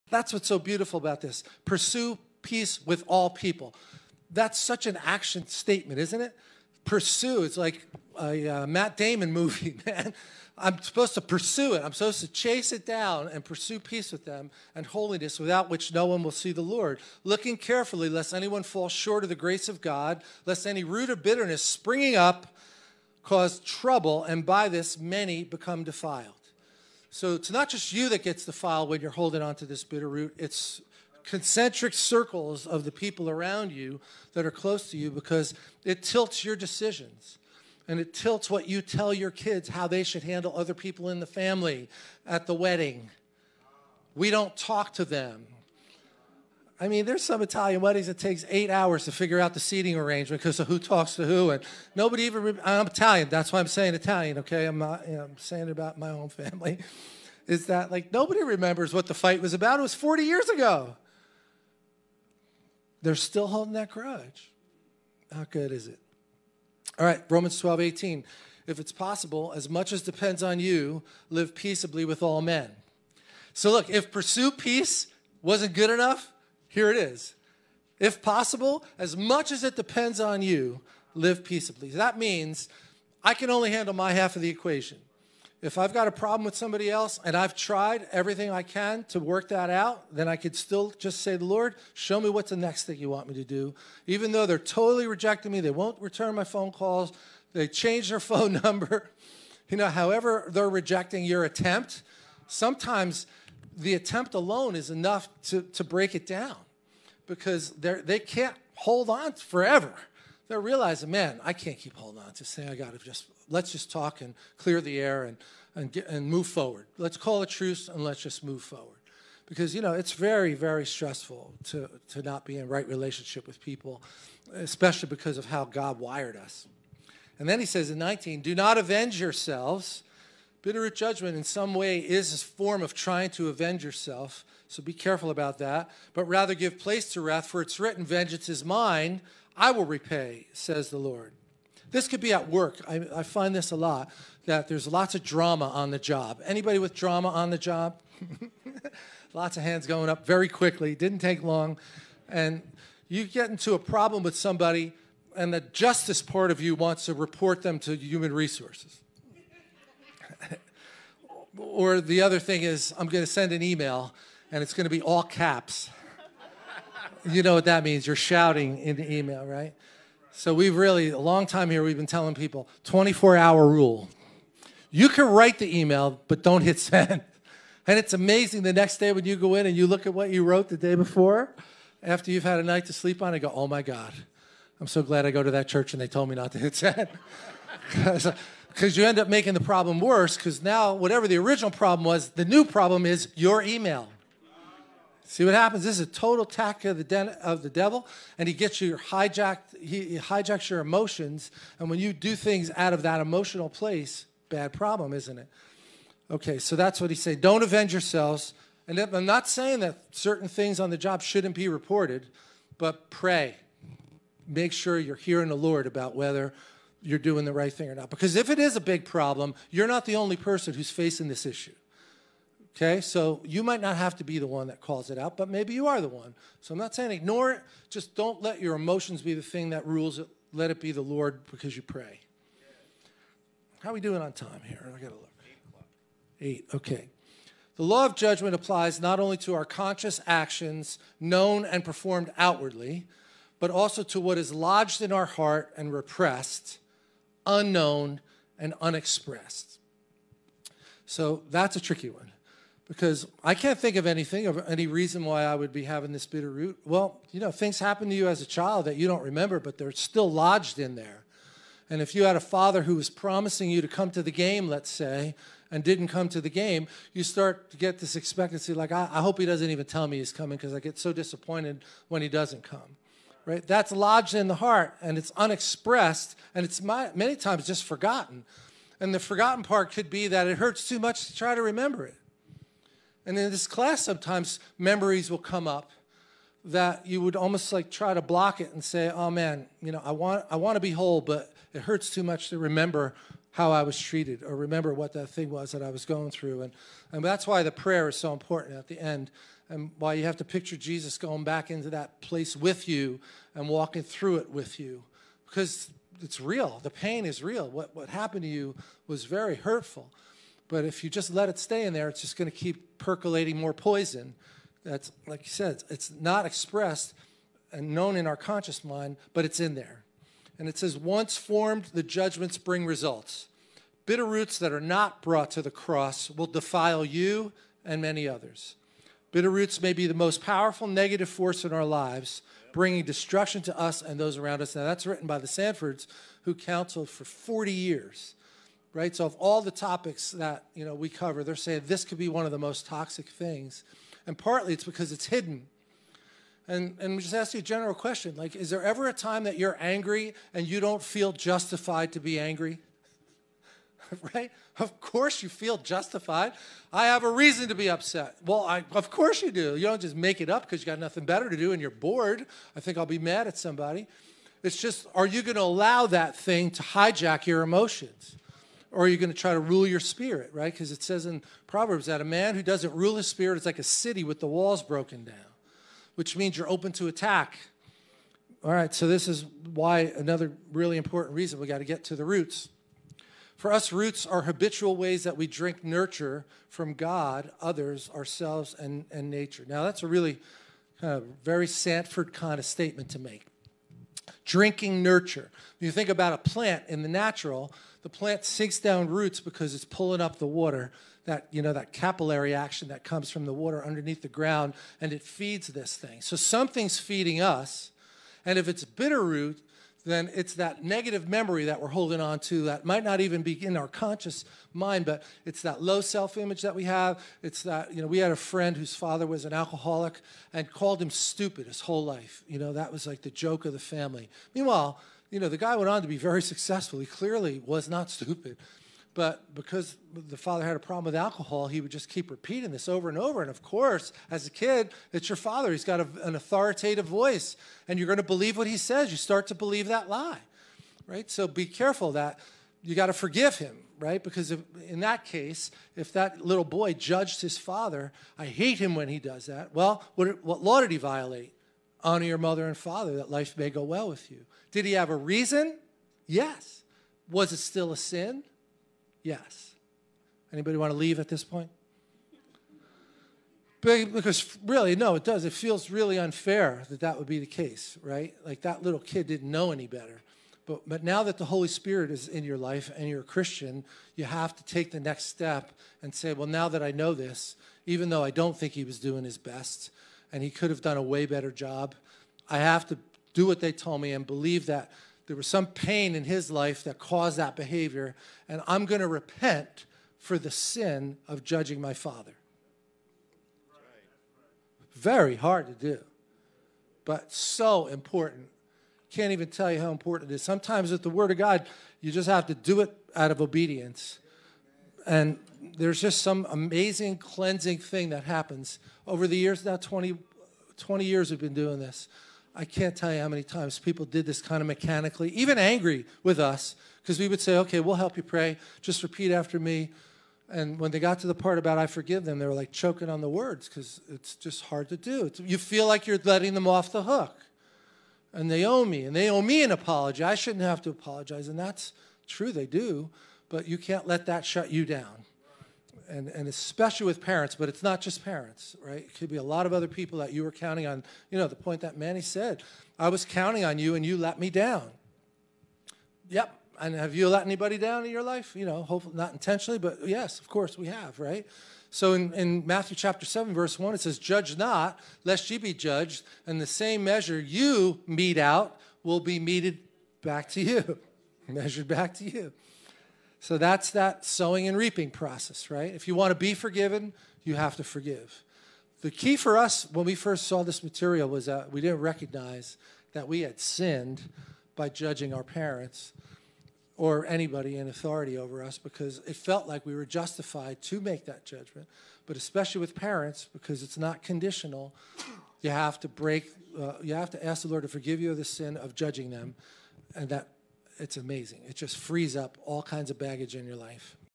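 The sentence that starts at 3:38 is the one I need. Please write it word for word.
Because if it is a big problem, you're not the only person who's facing this issue.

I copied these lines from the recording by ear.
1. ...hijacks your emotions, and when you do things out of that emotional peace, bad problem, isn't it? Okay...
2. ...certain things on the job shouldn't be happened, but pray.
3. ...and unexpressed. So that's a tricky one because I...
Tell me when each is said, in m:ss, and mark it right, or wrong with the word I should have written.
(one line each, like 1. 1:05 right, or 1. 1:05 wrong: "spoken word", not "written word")
1. 3:20 wrong: "place", not "peace"
2. 3:30 wrong: "reported", not "happened"
3. 4:08 right.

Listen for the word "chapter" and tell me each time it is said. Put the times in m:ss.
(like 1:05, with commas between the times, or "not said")
9:12.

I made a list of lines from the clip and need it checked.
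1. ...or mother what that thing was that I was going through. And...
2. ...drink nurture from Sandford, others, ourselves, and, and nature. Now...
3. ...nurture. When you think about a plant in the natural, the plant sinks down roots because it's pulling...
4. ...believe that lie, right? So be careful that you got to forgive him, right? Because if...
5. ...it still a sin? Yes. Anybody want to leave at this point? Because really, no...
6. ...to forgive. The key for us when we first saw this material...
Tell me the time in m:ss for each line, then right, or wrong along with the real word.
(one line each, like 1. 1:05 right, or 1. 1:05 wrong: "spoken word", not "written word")
1. 4:54 wrong: "remember", not "mother"
2. 6:25 wrong: "God", not "Sandford"
3. 6:35 right
4. 7:19 right
5. 7:37 right
6. 9:27 right.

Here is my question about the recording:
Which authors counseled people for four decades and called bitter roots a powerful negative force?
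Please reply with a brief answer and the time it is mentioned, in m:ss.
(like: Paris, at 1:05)
The Sandfords, at 5:35.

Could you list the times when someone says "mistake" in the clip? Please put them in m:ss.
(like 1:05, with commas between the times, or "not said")
not said.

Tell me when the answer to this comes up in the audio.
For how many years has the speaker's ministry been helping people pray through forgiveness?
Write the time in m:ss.
8:30.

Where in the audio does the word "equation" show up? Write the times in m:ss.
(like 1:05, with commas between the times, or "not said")
1:24.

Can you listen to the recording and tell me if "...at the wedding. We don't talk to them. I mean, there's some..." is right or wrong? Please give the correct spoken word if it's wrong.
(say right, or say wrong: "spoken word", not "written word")
right.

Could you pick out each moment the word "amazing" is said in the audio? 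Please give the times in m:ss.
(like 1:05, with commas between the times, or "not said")
2:58, 8:26, 9:51.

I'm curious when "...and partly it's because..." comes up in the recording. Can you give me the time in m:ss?
5:44.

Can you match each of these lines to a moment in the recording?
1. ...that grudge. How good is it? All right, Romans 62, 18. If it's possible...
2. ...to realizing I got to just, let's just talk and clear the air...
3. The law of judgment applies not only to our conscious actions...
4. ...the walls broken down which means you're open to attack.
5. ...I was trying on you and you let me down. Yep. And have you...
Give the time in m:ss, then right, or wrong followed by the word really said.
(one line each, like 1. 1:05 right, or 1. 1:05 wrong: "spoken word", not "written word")
1. 1:03 wrong: "12", not "62"
2. 1:52 wrong: "saying", not "realizing"
3. 3:57 right
4. 6:14 right
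5. 9:02 wrong: "counting", not "trying".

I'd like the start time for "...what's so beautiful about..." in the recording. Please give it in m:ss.
0:00.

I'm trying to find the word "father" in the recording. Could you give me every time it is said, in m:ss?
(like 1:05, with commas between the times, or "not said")
4:22, 6:58, 7:10, 7:15, 7:27, 7:32, 8:11.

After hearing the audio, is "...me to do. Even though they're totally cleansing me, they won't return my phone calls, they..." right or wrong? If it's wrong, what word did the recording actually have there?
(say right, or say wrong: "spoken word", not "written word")
wrong: "rejecting", not "cleansing".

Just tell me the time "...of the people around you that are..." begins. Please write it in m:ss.
0:32.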